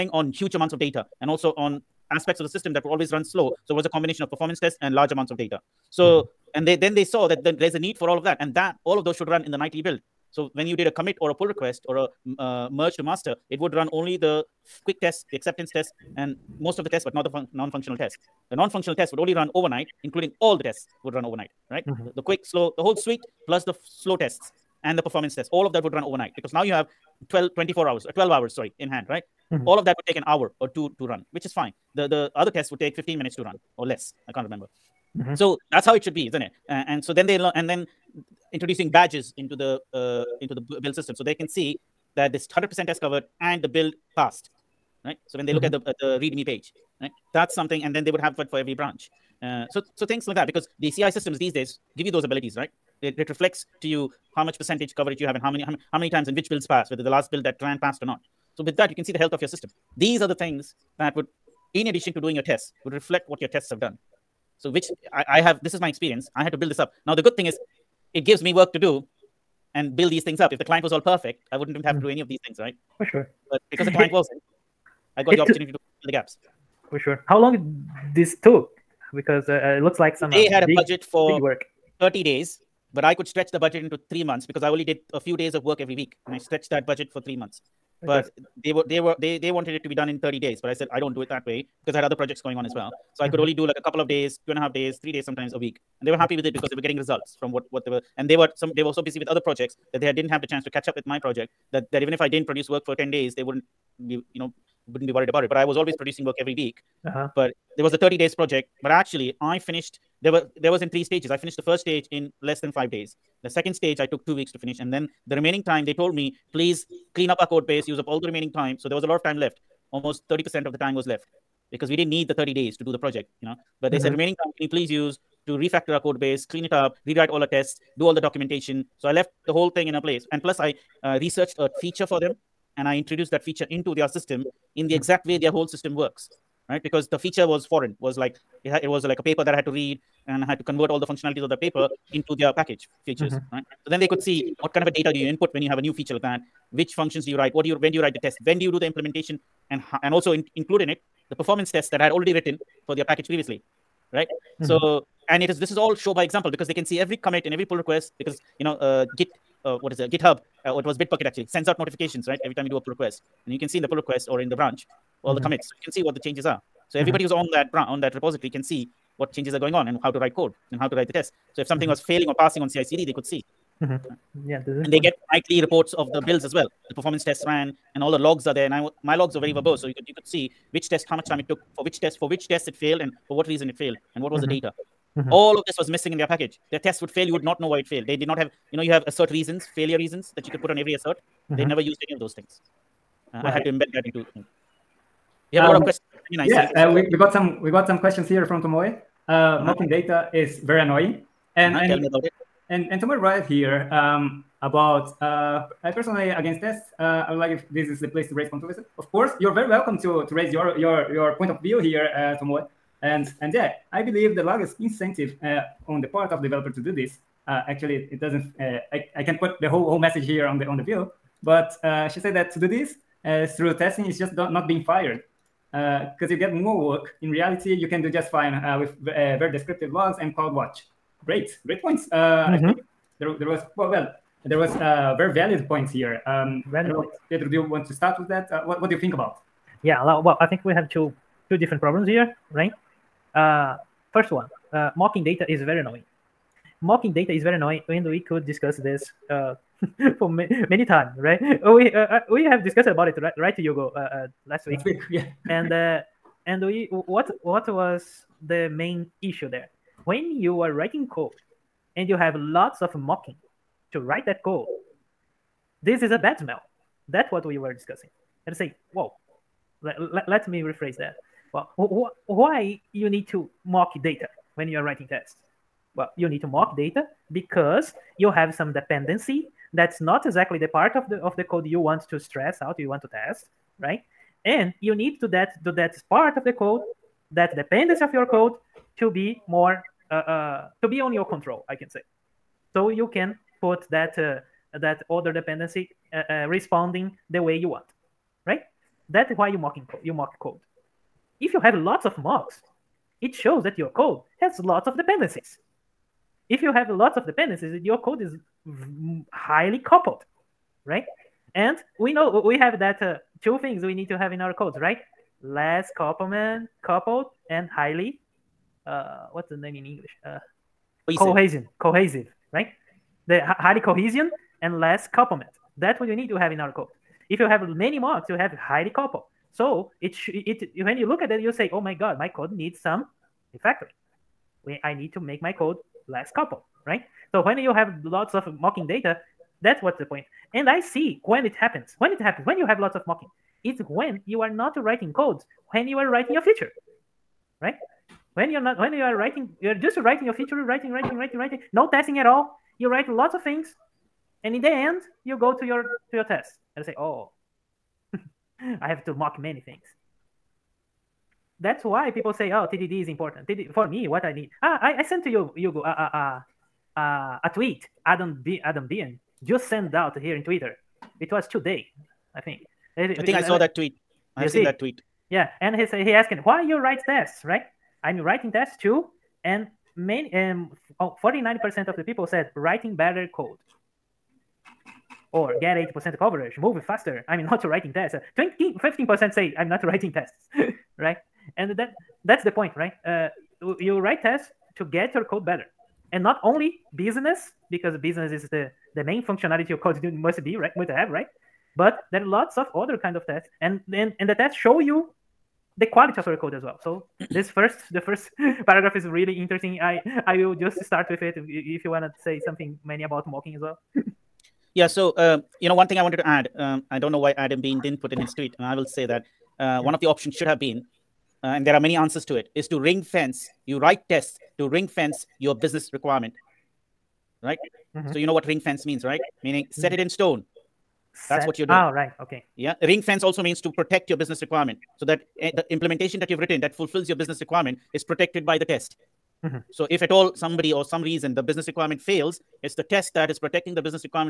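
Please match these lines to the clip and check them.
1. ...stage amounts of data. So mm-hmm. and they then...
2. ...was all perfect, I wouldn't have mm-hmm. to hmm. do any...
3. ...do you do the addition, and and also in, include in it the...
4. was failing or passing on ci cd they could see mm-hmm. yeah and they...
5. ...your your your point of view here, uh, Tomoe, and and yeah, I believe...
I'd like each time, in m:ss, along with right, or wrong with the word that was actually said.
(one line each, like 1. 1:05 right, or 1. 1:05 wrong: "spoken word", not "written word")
1. 0:04 wrong: "large", not "stage"
2. 1:10 right
3. 2:28 wrong: "implementation", not "addition"
4. 2:51 right
5. 3:30 right.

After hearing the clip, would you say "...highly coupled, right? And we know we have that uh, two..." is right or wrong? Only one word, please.
right.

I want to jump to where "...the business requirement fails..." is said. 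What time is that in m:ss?
7:21.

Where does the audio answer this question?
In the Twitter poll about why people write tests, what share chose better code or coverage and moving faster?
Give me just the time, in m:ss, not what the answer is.
6:21.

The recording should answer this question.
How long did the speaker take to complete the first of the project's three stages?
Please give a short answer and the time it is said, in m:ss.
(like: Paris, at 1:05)
less than 5 days, at 1:52.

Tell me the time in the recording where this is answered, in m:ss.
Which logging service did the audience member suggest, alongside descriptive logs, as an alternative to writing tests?
3:50.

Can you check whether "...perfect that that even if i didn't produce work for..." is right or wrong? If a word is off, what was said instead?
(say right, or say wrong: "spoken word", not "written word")
wrong: "project", not "perfect".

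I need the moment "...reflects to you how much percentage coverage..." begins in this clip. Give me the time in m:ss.
0:53.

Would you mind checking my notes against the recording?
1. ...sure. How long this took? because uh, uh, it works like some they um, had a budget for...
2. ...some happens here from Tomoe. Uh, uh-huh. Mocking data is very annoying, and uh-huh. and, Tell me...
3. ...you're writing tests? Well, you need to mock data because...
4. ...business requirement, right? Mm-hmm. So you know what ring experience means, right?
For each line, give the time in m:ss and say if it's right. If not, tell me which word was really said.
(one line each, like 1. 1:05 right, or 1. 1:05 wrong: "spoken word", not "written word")
1. 1:16 wrong: "looks", not "works"
2. 3:17 wrong: "questions", not "happens"
3. 4:34 right
4. 7:05 wrong: "fence", not "experience".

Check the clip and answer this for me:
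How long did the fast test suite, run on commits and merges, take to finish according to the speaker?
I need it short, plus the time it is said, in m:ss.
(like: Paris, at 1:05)
15 minutes, at 0:32.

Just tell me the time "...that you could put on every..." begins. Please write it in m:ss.
3:10.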